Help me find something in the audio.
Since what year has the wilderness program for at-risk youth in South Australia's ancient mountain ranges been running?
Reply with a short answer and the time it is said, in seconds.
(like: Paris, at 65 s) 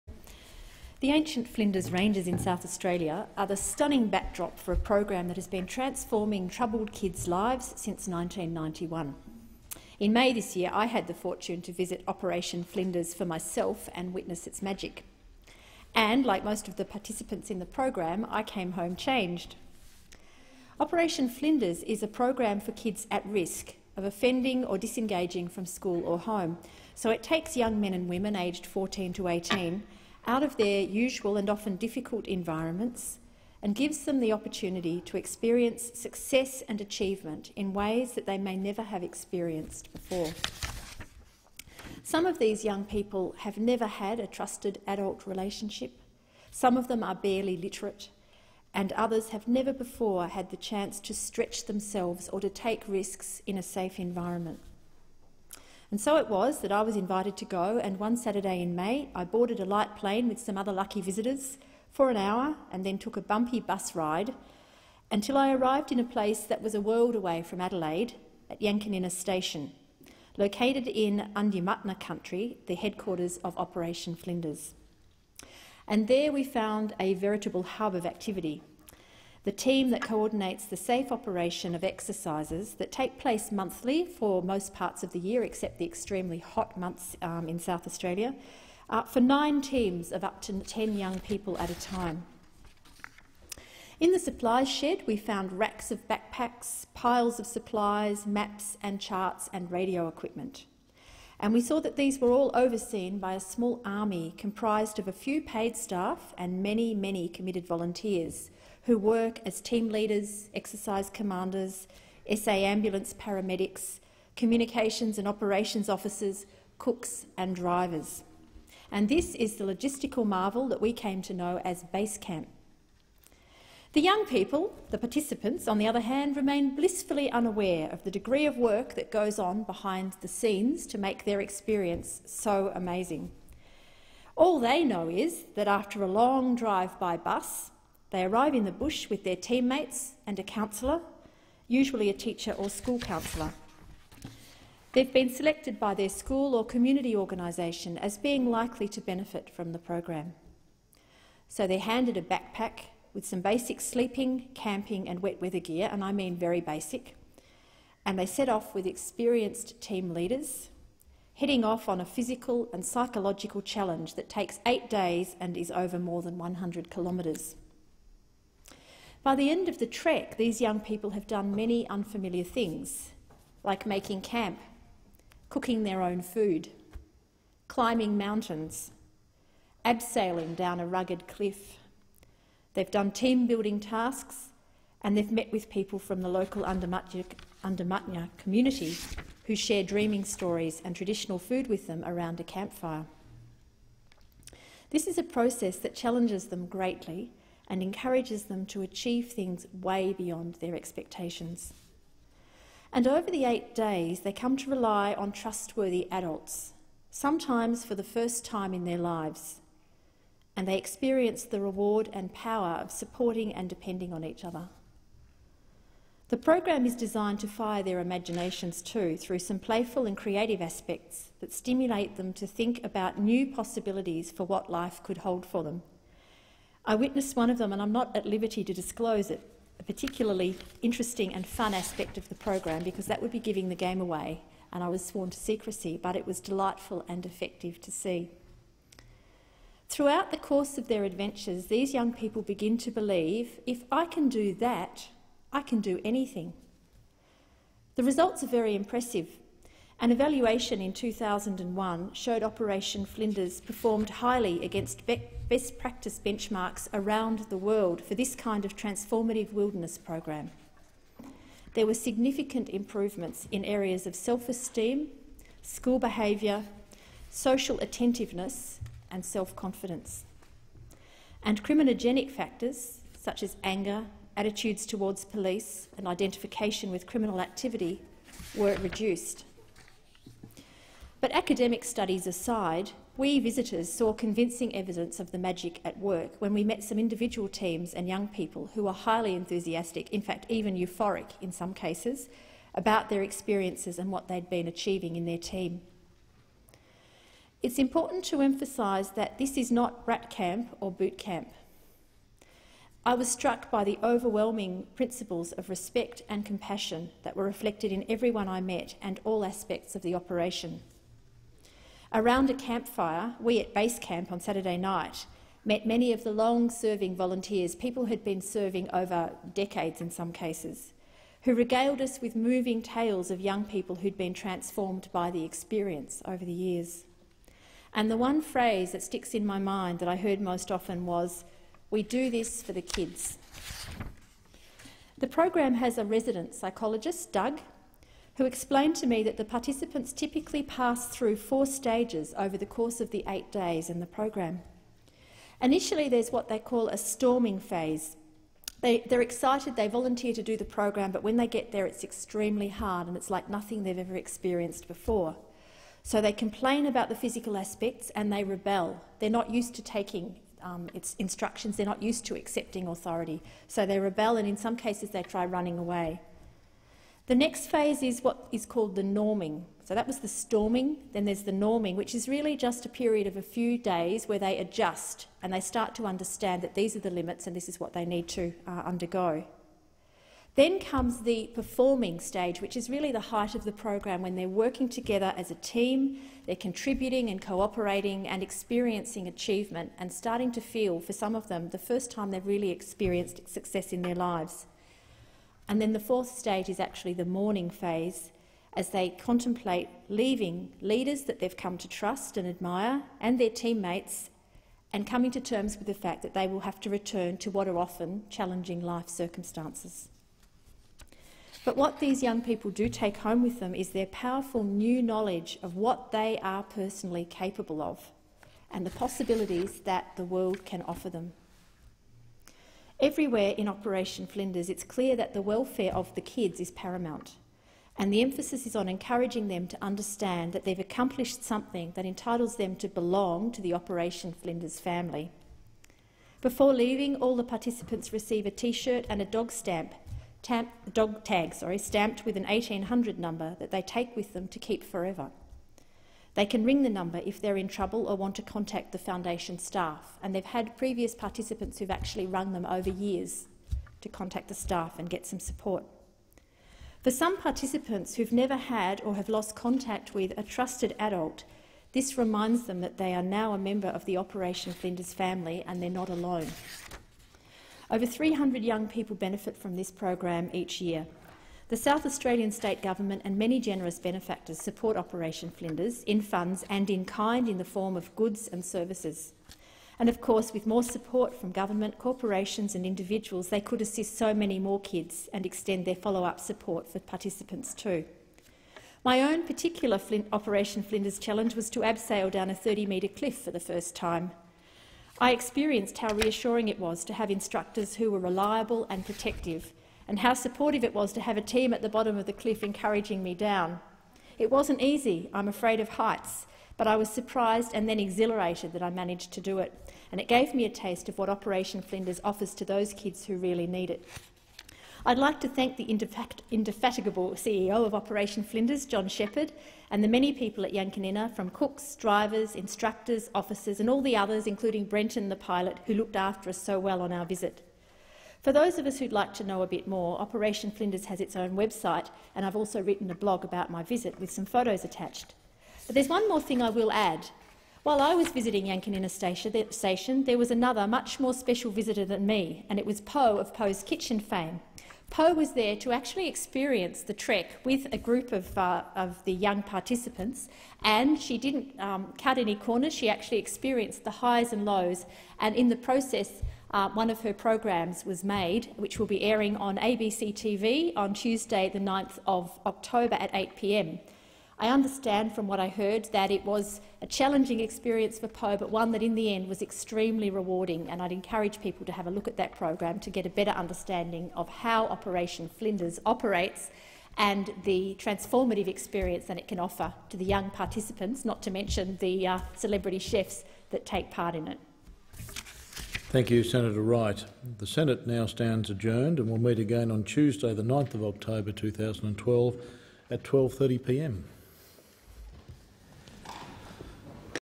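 1991, at 8 s.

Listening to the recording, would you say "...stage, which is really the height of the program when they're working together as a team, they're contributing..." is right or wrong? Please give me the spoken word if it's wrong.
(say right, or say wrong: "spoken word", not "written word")
right.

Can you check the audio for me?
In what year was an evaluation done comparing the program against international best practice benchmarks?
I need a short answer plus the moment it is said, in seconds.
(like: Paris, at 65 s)
2001, at 250 s.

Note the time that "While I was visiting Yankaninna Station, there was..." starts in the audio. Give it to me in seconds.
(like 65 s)
537 s.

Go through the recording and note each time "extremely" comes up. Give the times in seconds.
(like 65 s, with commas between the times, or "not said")
85 s, 352 s, 569 s.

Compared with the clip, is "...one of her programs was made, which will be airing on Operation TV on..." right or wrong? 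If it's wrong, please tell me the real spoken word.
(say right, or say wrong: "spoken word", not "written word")
wrong: "ABC", not "Operation".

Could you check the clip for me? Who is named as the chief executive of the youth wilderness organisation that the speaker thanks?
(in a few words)
John Shepherd.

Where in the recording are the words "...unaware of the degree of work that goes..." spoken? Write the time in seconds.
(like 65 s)
127 s.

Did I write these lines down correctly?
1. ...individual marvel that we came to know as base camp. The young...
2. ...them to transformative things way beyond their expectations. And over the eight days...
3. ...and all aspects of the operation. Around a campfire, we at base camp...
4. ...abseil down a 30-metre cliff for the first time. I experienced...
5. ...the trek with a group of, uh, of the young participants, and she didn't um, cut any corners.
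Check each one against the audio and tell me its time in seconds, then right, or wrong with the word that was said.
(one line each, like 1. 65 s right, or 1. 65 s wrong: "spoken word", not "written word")
1. 119 s wrong: "logistical", not "individual"
2. 198 s wrong: "achieve", not "transformative"
3. 309 s right
4. 491 s right
5. 547 s right.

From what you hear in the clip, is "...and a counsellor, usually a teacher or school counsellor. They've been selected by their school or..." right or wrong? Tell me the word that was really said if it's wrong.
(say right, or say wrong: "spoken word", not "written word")
right.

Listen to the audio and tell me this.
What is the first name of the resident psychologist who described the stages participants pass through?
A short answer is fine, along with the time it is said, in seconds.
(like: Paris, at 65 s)
Doug, at 337 s.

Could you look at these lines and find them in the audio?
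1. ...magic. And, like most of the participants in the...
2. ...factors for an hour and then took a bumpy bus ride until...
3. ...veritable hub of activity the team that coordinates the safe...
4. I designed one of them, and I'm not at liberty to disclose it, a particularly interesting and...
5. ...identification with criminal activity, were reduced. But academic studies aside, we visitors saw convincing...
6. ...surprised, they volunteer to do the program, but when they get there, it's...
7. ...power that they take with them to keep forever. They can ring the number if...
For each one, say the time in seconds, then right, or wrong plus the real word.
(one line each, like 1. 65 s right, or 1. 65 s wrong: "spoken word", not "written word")
1. 14 s right
2. 61 s wrong: "visitors", not "factors"
3. 77 s right
4. 226 s wrong: "witnessed", not "designed"
5. 276 s right
6. 349 s wrong: "excited", not "surprised"
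7. 443 s wrong: "number", not "power".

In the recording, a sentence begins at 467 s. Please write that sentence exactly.
Over 300 young people benefit from this program each year.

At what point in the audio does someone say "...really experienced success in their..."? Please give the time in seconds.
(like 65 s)
392 s.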